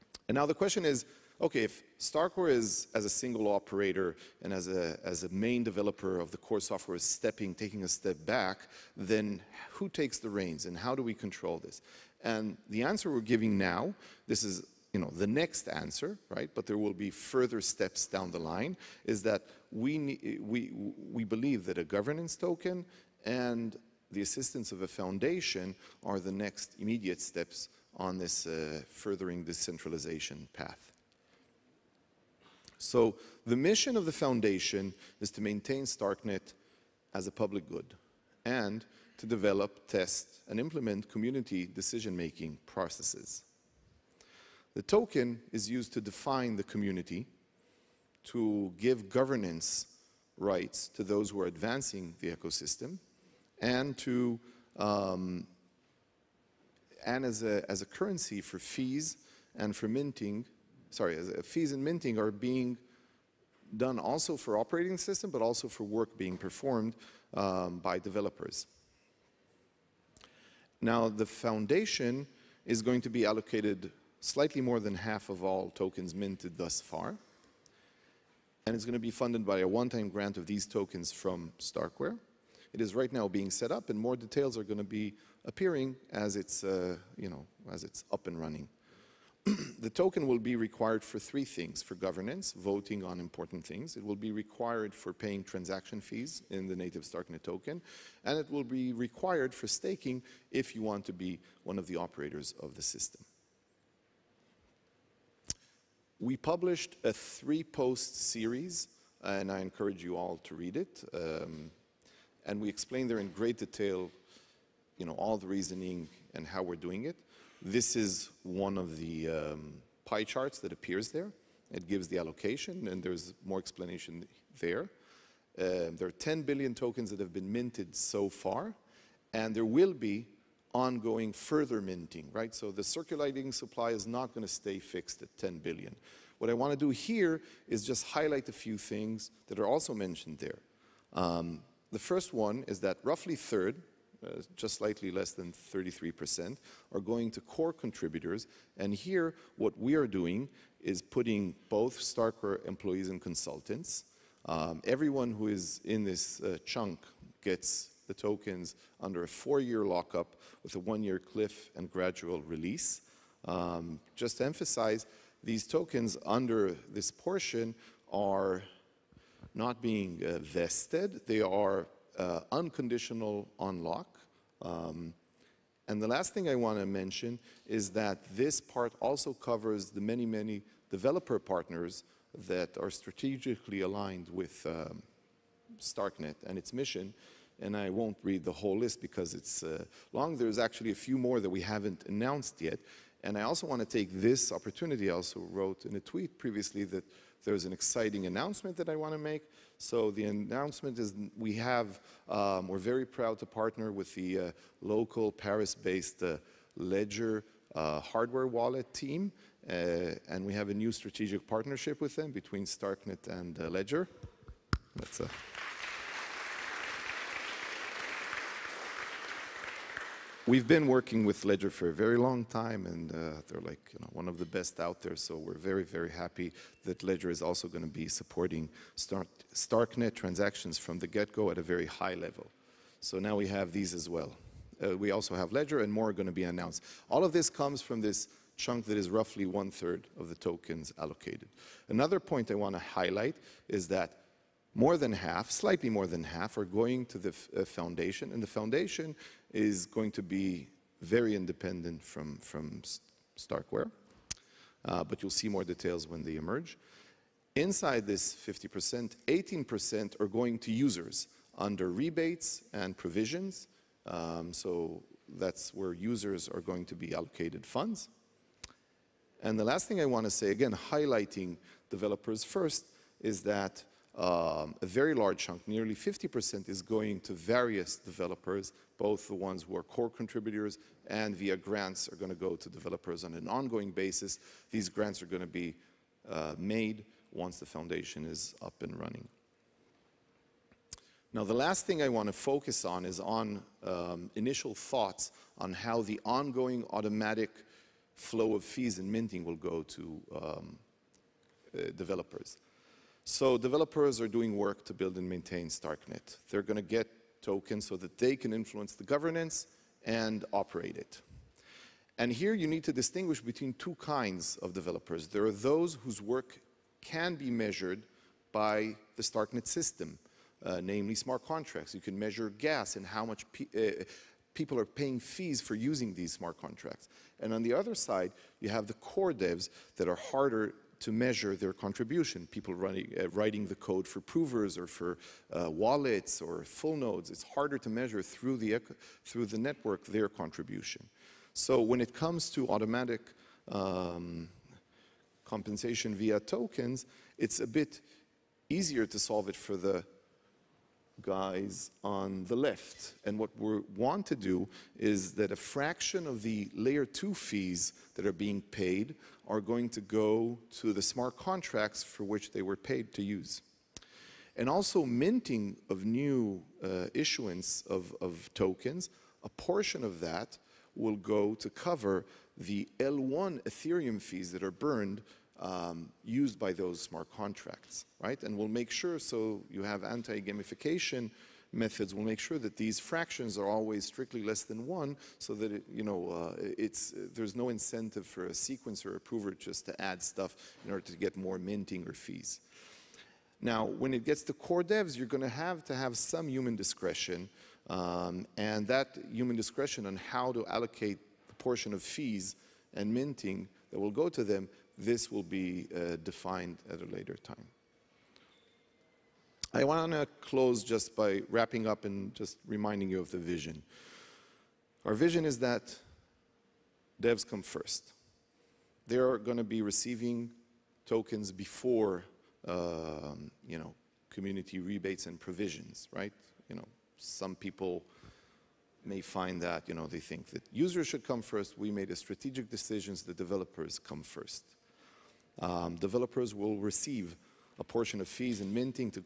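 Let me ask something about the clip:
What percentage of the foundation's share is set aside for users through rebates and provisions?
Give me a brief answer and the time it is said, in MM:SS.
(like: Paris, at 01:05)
18%, at 04:19.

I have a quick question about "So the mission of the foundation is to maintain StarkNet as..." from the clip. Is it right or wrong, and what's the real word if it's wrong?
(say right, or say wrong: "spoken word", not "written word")
right.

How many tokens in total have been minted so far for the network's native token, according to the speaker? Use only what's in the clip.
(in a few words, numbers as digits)
10 billion.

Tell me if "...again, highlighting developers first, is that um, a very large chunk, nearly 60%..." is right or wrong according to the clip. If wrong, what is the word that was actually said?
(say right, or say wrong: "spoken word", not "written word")
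wrong: "50", not "60".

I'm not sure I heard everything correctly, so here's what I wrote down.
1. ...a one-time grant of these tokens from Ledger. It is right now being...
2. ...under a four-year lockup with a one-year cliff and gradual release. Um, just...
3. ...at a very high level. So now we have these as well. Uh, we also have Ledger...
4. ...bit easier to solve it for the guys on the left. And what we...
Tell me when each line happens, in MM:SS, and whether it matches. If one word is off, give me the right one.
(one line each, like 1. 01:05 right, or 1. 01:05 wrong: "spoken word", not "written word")
1. 01:19 wrong: "Starkware", not "Ledger"
2. 02:38 right
3. 03:51 right
4. 05:47 right.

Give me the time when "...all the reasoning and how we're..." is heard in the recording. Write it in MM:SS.
01:55.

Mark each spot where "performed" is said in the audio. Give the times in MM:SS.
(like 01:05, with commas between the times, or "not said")
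01:06.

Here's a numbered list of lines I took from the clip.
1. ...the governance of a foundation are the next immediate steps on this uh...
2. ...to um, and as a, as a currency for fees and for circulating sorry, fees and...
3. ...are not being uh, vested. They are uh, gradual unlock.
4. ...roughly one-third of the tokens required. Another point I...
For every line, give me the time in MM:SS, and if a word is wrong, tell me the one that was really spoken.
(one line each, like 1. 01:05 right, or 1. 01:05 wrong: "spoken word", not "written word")
1. 00:24 wrong: "assistance", not "governance"
2. 00:53 wrong: "minting", not "circulating"
3. 02:48 wrong: "unconditional", not "gradual"
4. 03:59 wrong: "allocated", not "required".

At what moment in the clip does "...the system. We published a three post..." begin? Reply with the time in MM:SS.
01:42.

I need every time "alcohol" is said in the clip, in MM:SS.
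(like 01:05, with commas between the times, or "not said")
not said.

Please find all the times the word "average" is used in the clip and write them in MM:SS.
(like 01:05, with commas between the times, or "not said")
not said.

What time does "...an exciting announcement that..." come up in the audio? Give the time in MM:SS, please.
03:17.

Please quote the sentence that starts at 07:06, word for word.
You know, some people may find that, you know, they think that users should come first.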